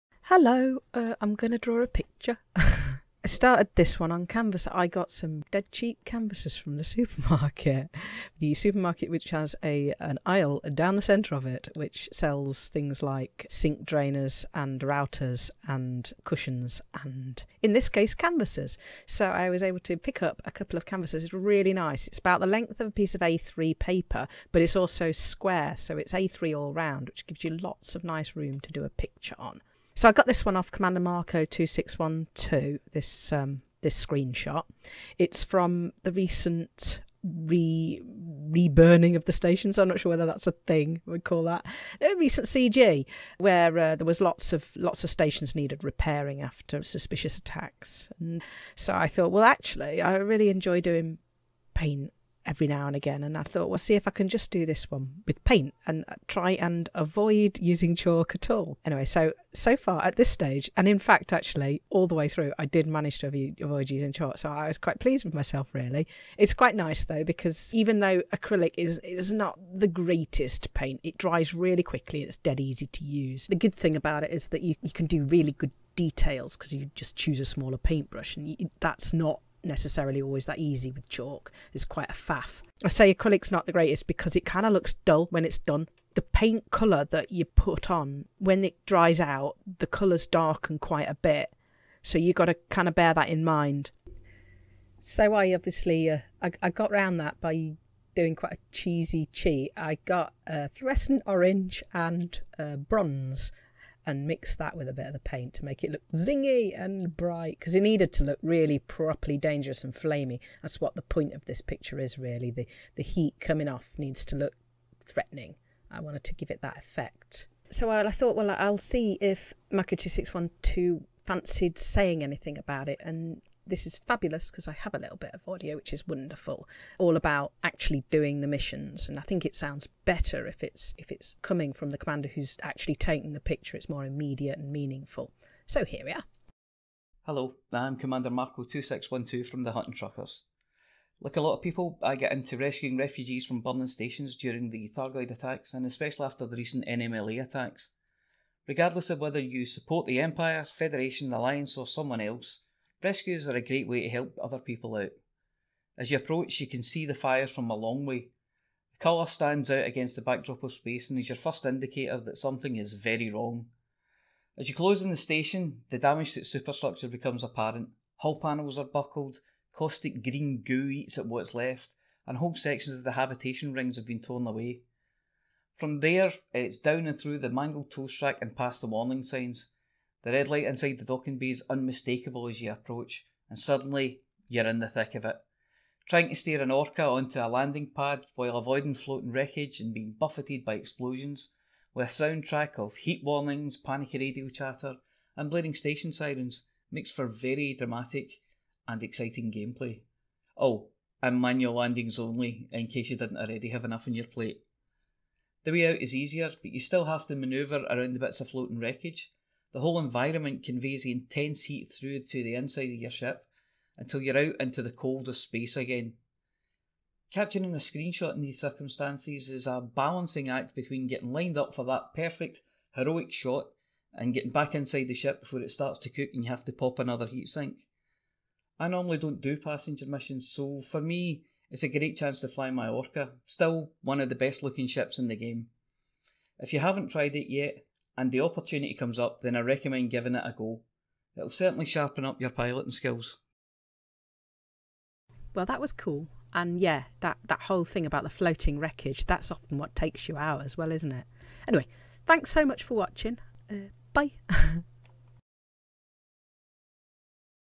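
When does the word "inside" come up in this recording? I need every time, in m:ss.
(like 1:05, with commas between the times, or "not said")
3:00, 3:32, 3:44.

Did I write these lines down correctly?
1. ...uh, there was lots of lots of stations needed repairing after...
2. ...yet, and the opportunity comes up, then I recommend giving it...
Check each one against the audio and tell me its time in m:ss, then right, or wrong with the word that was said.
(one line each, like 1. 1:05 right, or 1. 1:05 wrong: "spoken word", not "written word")
1. 0:43 right
2. 3:57 right.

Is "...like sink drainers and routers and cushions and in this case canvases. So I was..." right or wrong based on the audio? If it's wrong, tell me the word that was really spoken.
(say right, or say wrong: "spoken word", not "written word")
right.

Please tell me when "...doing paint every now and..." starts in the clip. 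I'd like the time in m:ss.
0:50.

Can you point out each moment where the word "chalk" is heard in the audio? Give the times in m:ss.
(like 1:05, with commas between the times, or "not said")
0:57, 1:04, 1:21.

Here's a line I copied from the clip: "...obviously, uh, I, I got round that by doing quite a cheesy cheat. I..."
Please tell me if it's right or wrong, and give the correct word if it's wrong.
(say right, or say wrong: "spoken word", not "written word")
right.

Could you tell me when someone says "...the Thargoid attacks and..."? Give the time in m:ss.
2:24.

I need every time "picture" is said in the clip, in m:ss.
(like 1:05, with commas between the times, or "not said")
0:01, 0:28, 1:51, 2:13.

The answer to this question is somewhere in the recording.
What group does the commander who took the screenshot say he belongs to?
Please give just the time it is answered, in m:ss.
2:19.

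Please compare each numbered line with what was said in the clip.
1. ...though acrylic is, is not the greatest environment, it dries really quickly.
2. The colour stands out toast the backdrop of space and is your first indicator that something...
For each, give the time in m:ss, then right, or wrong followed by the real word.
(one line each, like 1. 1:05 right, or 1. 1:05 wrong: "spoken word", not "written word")
1. 1:07 wrong: "paint", not "environment"
2. 2:38 wrong: "against", not "toast".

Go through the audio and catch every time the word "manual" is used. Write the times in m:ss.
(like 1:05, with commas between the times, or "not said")
3:21.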